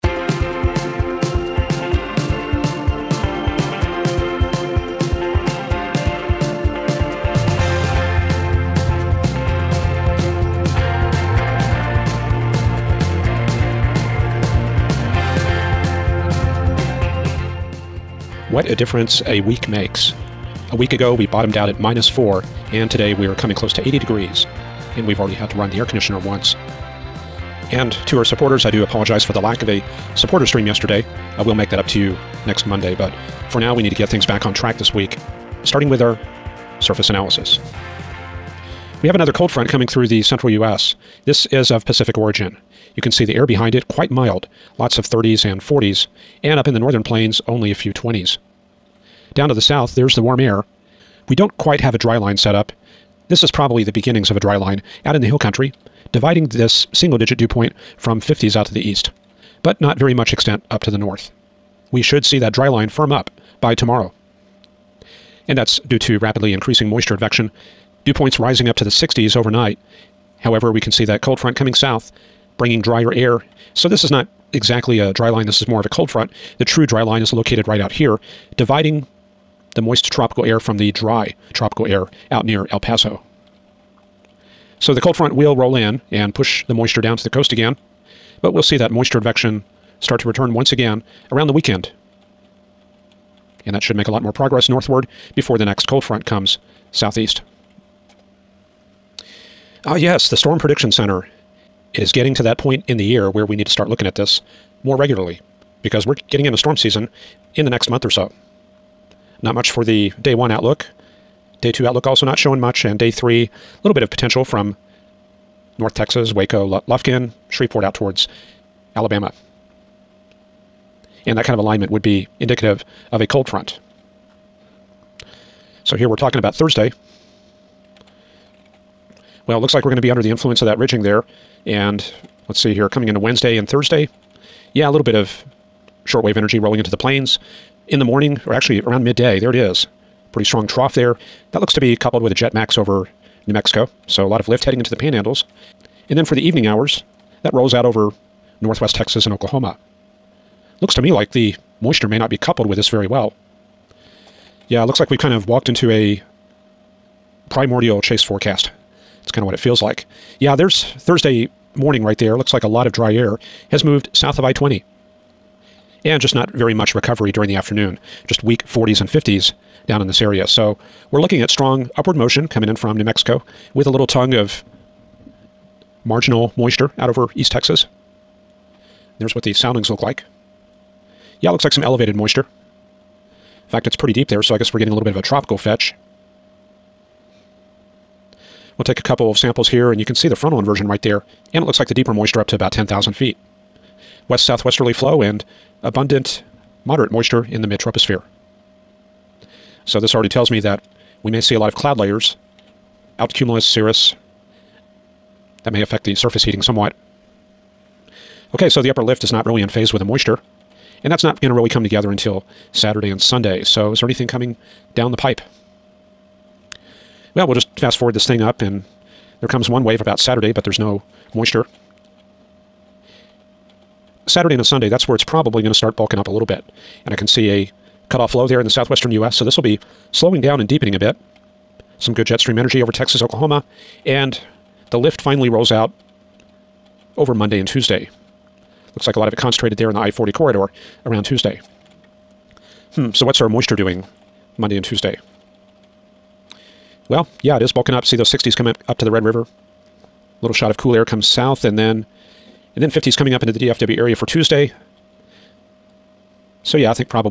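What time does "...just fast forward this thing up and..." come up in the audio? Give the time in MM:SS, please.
03:37.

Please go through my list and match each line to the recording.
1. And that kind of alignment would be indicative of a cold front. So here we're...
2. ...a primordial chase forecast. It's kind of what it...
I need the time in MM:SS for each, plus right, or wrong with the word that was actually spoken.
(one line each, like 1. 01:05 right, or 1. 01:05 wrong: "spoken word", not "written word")
1. 02:01 right
2. 02:35 right.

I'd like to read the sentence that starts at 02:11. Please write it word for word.
And let's see here, coming into Wednesday and Thursday.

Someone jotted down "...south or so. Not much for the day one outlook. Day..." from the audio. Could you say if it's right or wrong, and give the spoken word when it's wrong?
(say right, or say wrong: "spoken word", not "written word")
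wrong: "month", not "south".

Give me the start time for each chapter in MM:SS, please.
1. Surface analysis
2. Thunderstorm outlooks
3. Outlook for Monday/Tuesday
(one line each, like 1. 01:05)
1. 00:38
2. 01:38
3. 03:35.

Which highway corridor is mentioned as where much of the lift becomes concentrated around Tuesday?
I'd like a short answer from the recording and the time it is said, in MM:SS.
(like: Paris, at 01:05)
I-40, at 03:59.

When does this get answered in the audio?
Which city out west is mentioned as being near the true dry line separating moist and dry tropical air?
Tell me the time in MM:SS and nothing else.
01:22.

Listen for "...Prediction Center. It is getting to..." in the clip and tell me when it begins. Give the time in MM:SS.
01:40.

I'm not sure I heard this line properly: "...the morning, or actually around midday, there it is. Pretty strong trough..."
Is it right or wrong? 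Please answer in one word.
right.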